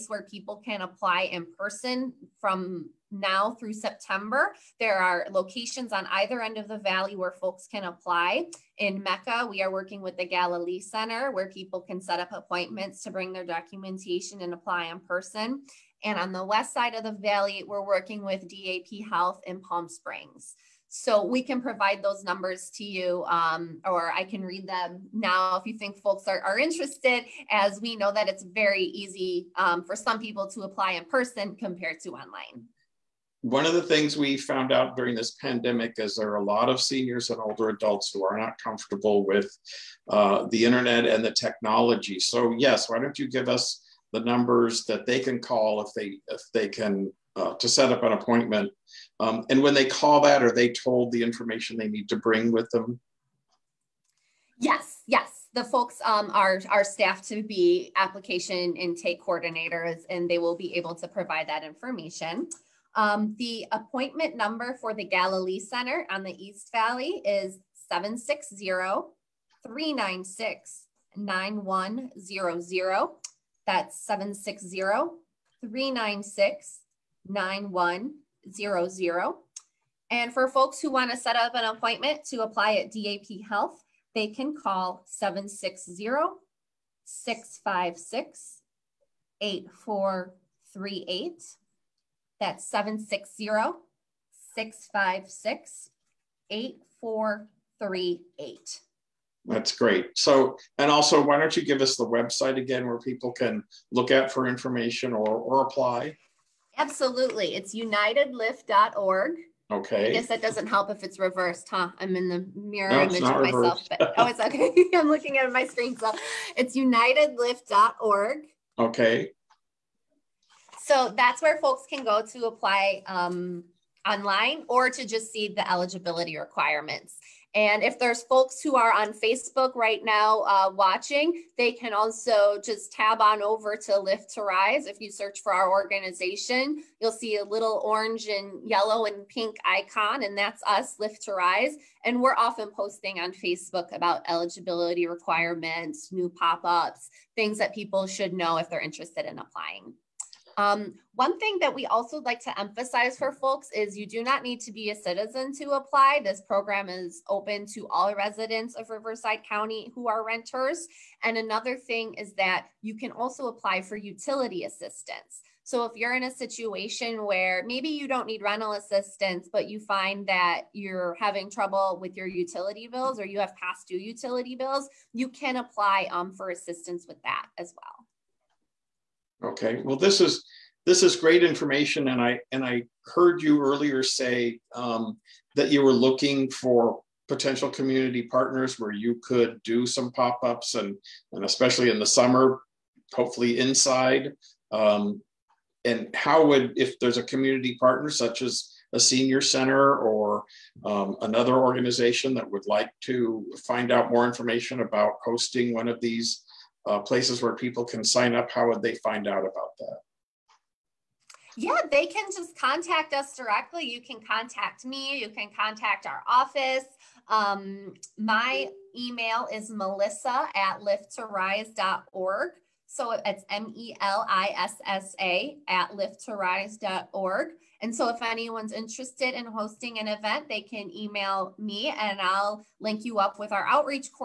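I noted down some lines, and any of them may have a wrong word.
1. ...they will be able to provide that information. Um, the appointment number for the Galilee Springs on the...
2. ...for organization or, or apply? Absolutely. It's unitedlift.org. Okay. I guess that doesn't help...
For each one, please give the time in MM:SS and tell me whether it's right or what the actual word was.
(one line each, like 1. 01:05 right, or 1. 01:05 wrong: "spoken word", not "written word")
1. 01:00 wrong: "Center", not "Springs"
2. 01:44 wrong: "information", not "organization".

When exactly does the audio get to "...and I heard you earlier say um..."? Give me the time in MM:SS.
03:02.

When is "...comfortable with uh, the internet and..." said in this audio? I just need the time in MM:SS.
00:38.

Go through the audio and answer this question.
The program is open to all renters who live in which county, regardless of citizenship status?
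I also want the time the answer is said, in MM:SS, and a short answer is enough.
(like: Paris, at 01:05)
Riverside County, at 02:38.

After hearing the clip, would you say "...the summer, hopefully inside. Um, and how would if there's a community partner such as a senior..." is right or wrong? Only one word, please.
right.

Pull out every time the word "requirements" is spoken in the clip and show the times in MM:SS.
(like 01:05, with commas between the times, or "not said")
02:06, 02:25.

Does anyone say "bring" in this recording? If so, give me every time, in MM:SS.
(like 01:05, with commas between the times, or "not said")
00:13, 00:52.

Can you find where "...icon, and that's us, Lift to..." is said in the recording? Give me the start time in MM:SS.
02:19.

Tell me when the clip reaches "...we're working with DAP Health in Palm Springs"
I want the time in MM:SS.
00:17.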